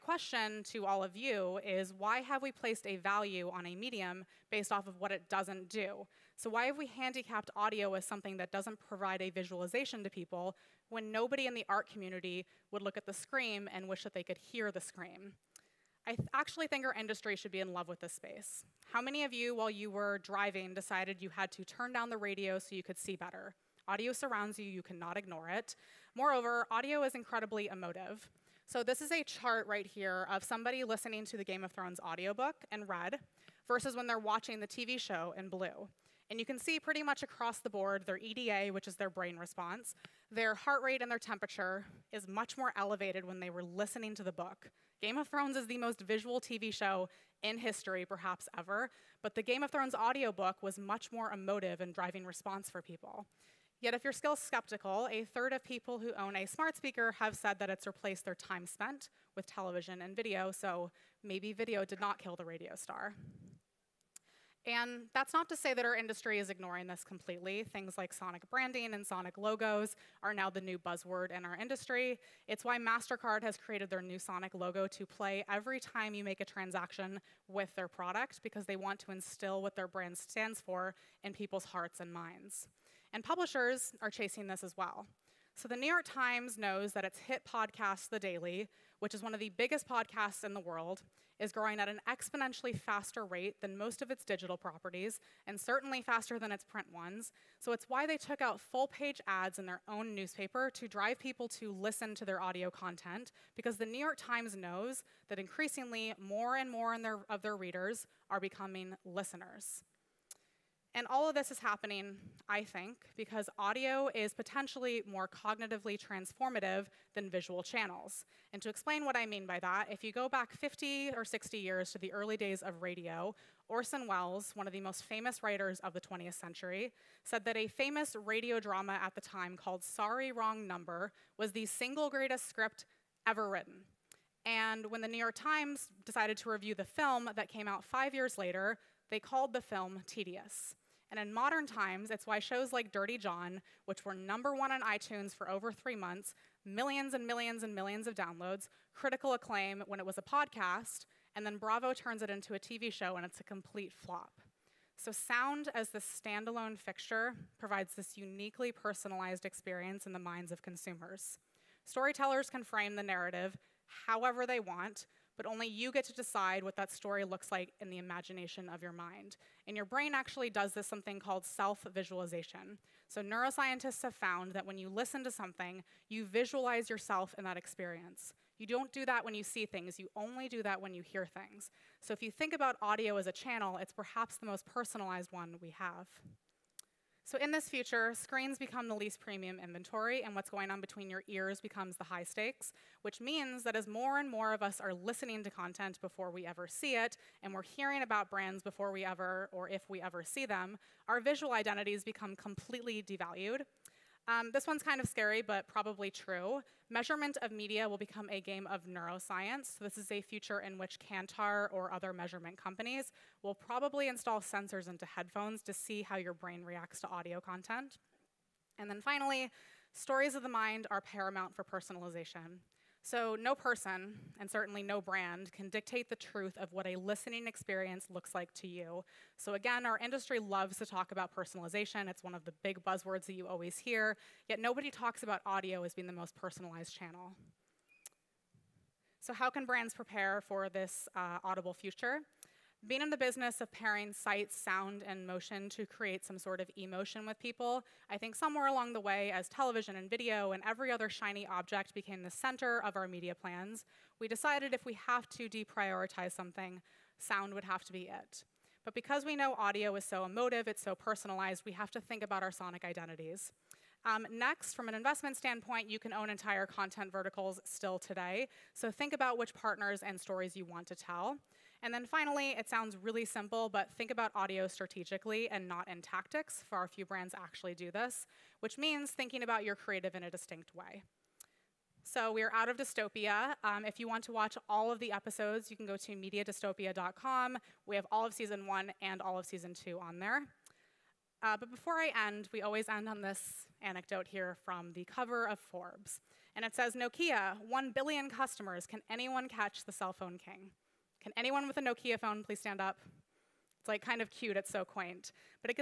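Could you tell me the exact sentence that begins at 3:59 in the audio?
So, how can brands prepare for this uh, audible future?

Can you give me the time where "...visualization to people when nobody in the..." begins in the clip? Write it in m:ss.
0:09.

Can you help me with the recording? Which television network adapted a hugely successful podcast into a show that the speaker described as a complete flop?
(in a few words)
Bravo.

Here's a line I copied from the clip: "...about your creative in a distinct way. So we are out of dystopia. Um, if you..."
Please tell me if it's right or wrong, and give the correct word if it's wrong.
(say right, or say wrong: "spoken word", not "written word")
right.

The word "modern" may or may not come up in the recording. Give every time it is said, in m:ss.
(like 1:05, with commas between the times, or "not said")
2:21.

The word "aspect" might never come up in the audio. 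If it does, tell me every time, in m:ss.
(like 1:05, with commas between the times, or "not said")
not said.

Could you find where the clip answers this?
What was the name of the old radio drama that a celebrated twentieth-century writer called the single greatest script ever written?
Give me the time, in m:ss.
2:09.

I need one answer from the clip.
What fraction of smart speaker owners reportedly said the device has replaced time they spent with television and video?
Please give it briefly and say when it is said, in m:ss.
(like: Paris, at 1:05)
a third, at 0:55.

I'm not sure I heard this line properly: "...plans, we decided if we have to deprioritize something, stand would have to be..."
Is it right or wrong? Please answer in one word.
wrong.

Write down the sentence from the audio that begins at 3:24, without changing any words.
Um, this one's kind of scary, but probably true.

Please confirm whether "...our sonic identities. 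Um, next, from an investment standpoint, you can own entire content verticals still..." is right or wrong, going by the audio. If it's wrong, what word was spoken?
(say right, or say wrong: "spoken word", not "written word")
right.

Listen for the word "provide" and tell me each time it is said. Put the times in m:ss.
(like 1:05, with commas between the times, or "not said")
0:08, 2:37.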